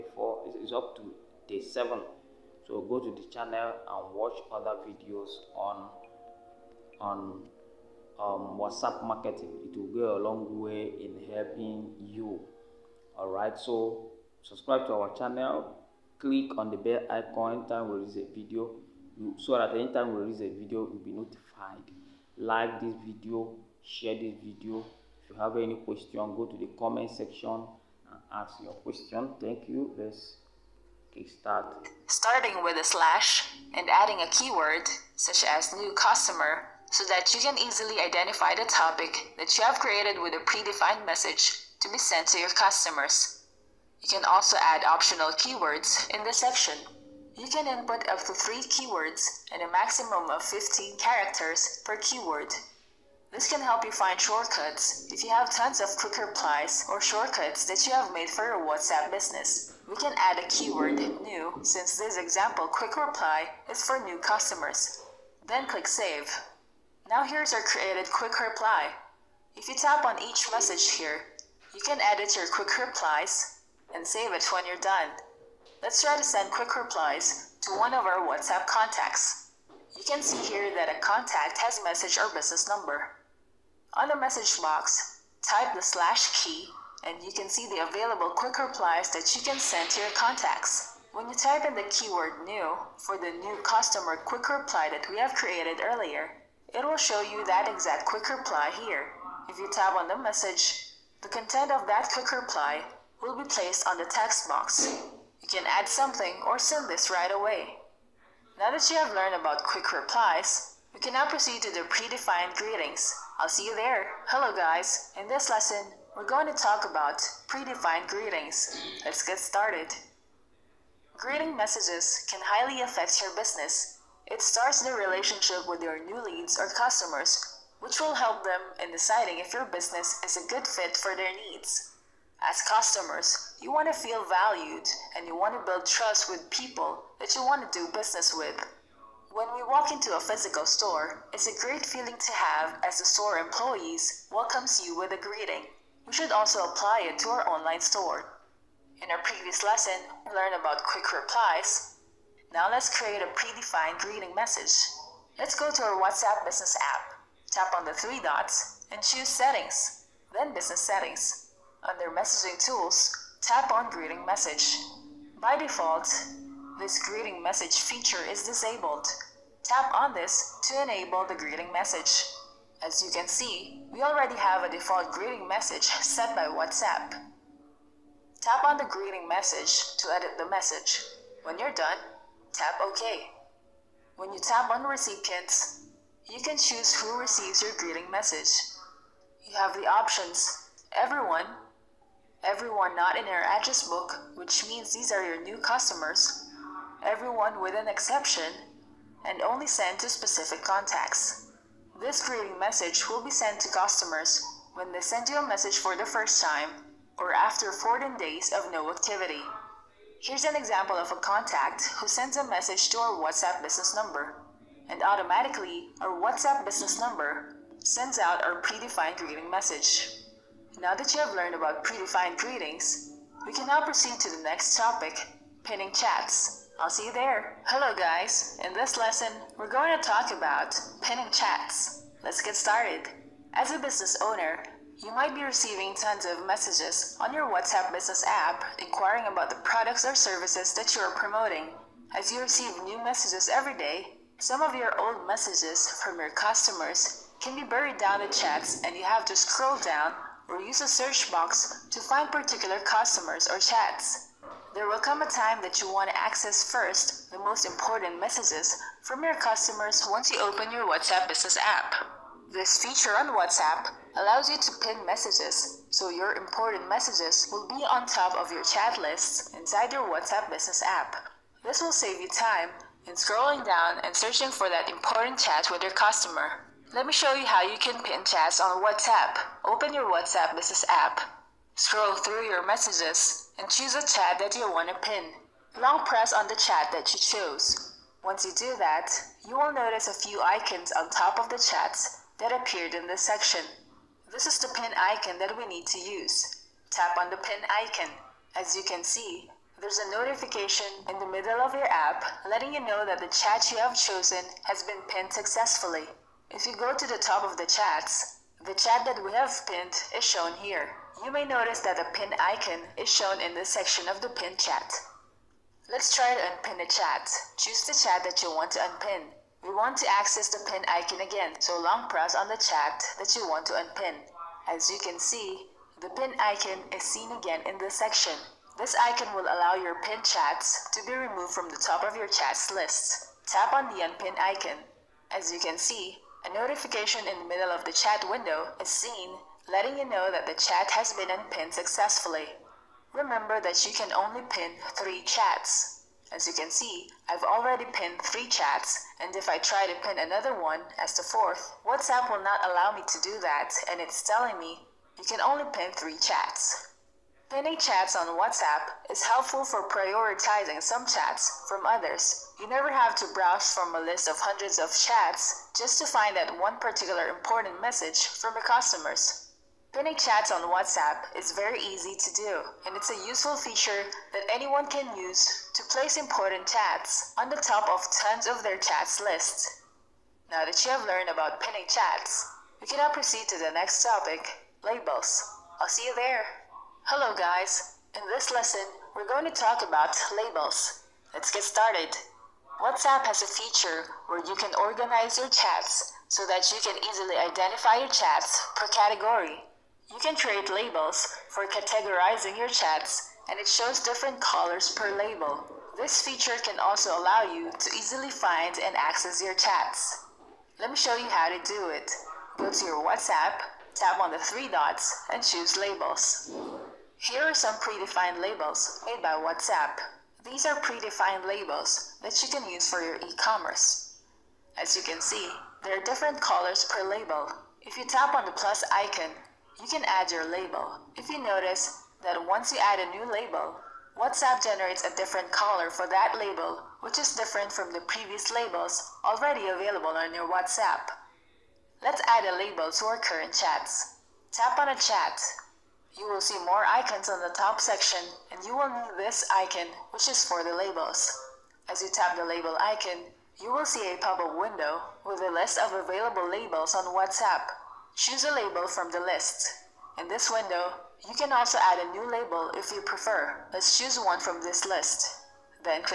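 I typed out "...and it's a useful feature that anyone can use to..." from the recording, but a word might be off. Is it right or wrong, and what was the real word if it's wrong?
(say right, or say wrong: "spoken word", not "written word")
right.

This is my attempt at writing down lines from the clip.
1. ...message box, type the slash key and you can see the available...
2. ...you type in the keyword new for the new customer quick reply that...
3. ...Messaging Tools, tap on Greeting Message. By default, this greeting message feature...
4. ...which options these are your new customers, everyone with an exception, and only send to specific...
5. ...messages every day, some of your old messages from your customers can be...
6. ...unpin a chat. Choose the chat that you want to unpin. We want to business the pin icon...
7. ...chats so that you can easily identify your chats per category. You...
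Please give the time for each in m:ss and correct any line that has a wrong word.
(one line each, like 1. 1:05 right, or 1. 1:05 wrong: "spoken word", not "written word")
1. 1:24 right
2. 1:31 right
3. 2:42 right
4. 3:14 wrong: "means", not "options"
5. 4:03 right
6. 5:16 wrong: "access", not "business"
7. 6:35 right.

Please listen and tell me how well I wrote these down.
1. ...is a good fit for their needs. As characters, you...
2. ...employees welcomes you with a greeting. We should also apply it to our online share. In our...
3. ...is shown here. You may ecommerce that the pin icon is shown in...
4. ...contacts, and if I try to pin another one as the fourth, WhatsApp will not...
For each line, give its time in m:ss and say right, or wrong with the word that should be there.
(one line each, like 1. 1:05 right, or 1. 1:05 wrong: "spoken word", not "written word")
1. 2:10 wrong: "customers", not "characters"
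2. 2:23 wrong: "store", not "share"
3. 5:10 wrong: "notice", not "ecommerce"
4. 5:48 wrong: "chats", not "contacts".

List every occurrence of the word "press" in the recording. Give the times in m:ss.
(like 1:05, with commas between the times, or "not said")
4:46, 5:22.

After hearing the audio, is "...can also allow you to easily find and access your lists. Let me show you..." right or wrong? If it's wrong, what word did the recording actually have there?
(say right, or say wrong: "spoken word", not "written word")
wrong: "chats", not "lists".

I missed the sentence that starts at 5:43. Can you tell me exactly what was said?
Remember that you can only pin 3 chats.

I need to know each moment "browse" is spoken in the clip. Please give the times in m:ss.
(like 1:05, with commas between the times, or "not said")
6:03.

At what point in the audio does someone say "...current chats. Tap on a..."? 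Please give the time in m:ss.
7:23.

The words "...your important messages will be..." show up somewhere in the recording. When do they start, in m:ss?
4:26.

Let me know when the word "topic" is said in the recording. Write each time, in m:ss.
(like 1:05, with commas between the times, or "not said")
0:38, 3:44, 6:24.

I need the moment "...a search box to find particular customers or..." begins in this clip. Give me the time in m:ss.
4:10.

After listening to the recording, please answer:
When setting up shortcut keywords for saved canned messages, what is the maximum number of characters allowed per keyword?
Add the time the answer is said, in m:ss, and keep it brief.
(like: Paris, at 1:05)
15, at 0:50.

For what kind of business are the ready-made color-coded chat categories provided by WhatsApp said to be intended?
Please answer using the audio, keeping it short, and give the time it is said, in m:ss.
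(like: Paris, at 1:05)
E-commerce, at 7:03.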